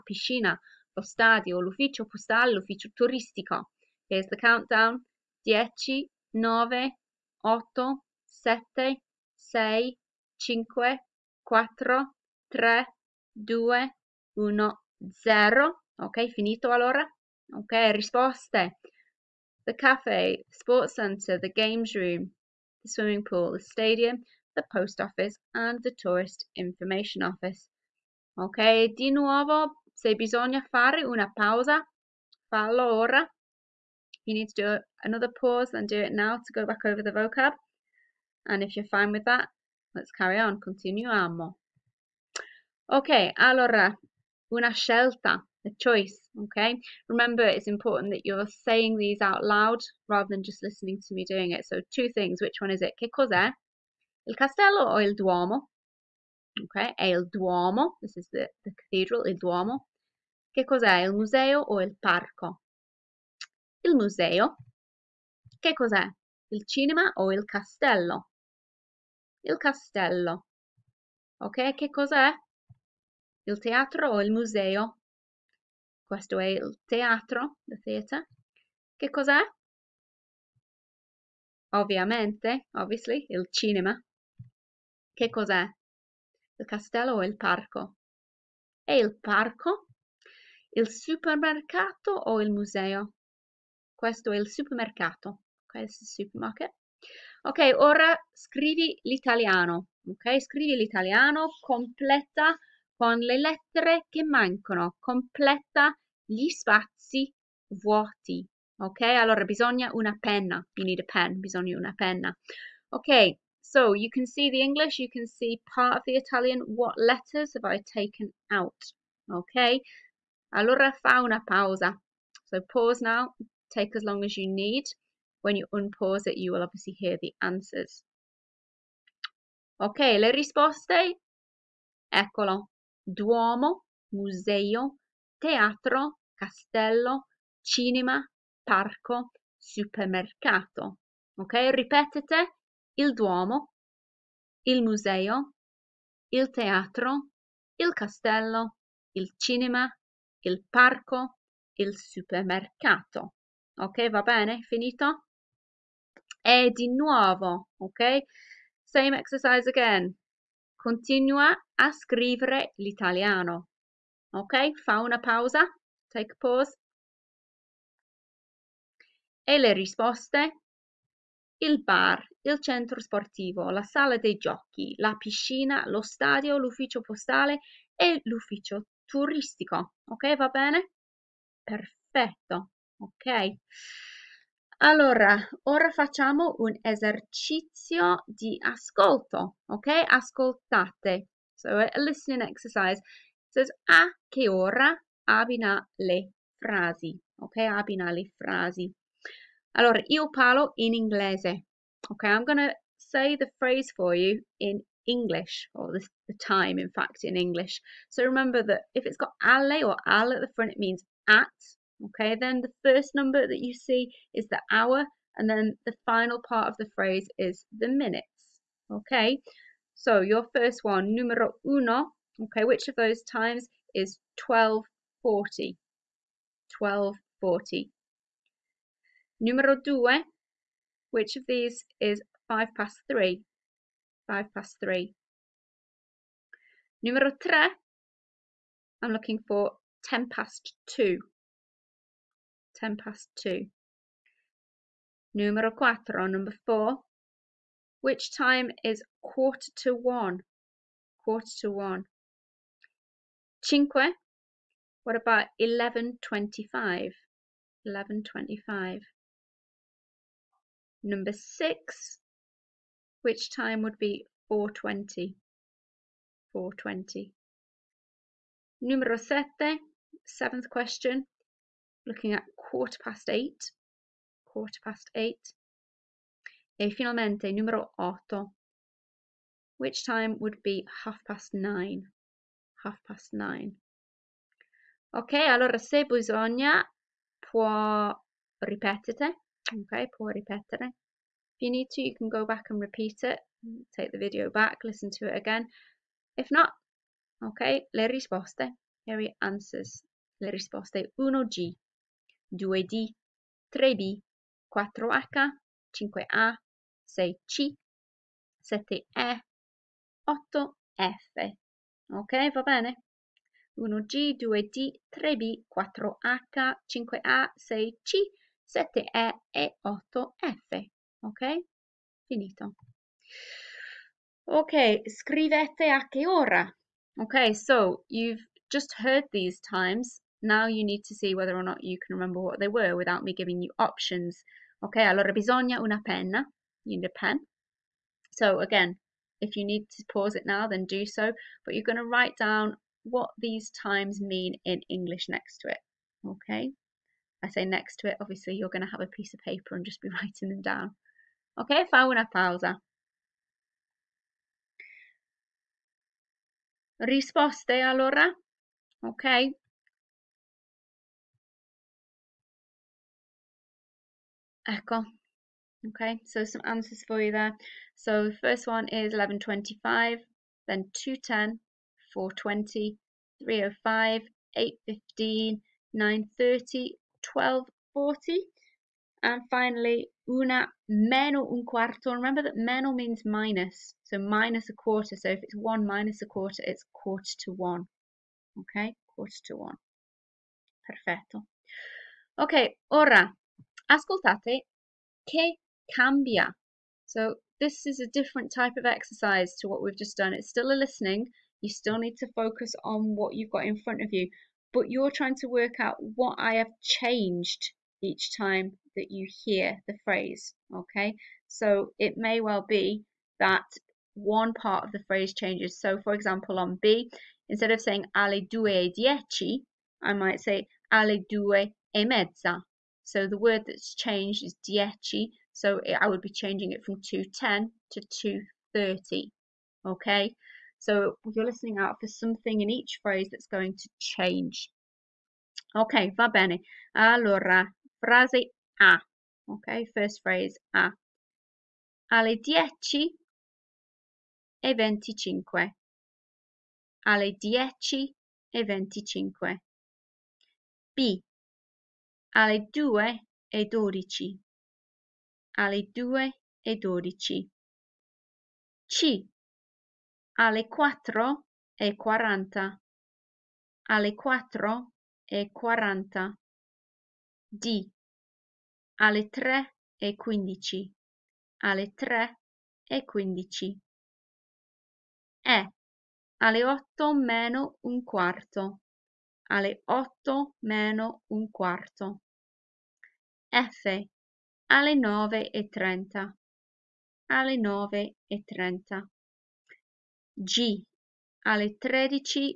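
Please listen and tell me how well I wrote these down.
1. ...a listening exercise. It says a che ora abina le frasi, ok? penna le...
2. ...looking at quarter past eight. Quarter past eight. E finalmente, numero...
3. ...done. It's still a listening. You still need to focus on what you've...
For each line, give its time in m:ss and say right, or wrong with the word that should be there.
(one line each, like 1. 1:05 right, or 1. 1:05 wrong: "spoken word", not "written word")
1. 3:11 wrong: "abina", not "penna"
2. 4:32 right
3. 6:40 right.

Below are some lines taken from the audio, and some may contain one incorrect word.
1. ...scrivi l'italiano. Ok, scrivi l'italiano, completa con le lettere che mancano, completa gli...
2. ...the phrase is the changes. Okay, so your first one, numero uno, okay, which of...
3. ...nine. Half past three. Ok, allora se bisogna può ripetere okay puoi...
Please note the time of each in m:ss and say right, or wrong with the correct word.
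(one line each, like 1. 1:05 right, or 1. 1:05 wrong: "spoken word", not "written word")
1. 1:38 right
2. 3:36 wrong: "minutes", not "changes"
3. 4:41 wrong: "nine", not "three".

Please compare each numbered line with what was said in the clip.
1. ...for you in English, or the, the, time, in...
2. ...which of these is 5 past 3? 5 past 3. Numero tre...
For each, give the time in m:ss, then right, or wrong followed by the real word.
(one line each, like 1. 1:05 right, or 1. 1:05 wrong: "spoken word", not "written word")
1. 3:23 right
2. 3:51 right.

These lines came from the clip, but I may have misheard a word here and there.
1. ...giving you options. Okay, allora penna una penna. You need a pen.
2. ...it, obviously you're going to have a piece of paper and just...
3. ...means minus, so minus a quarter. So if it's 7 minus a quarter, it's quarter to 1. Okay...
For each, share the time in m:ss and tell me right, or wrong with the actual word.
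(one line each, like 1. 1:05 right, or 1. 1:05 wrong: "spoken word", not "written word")
1. 5:33 wrong: "bisogna", not "penna"
2. 5:48 right
3. 6:22 wrong: "1", not "7".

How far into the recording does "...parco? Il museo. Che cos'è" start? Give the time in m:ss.
1:01.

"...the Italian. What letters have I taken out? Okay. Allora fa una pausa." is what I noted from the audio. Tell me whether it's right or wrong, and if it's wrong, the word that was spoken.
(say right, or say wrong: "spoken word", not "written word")
right.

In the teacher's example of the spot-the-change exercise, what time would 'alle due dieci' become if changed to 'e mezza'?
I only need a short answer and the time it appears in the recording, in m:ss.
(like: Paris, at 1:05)
2:30, at 7:07.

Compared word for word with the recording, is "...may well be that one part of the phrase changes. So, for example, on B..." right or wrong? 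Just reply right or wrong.
right.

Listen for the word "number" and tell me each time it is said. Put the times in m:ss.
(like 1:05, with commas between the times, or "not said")
3:33, 4:06, 4:21.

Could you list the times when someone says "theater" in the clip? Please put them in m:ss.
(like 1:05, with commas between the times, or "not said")
1:17.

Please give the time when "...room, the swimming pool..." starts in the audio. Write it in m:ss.
0:21.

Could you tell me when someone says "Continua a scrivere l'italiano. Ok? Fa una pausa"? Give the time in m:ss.
2:40.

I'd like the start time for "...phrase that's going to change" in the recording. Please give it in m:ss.
7:13.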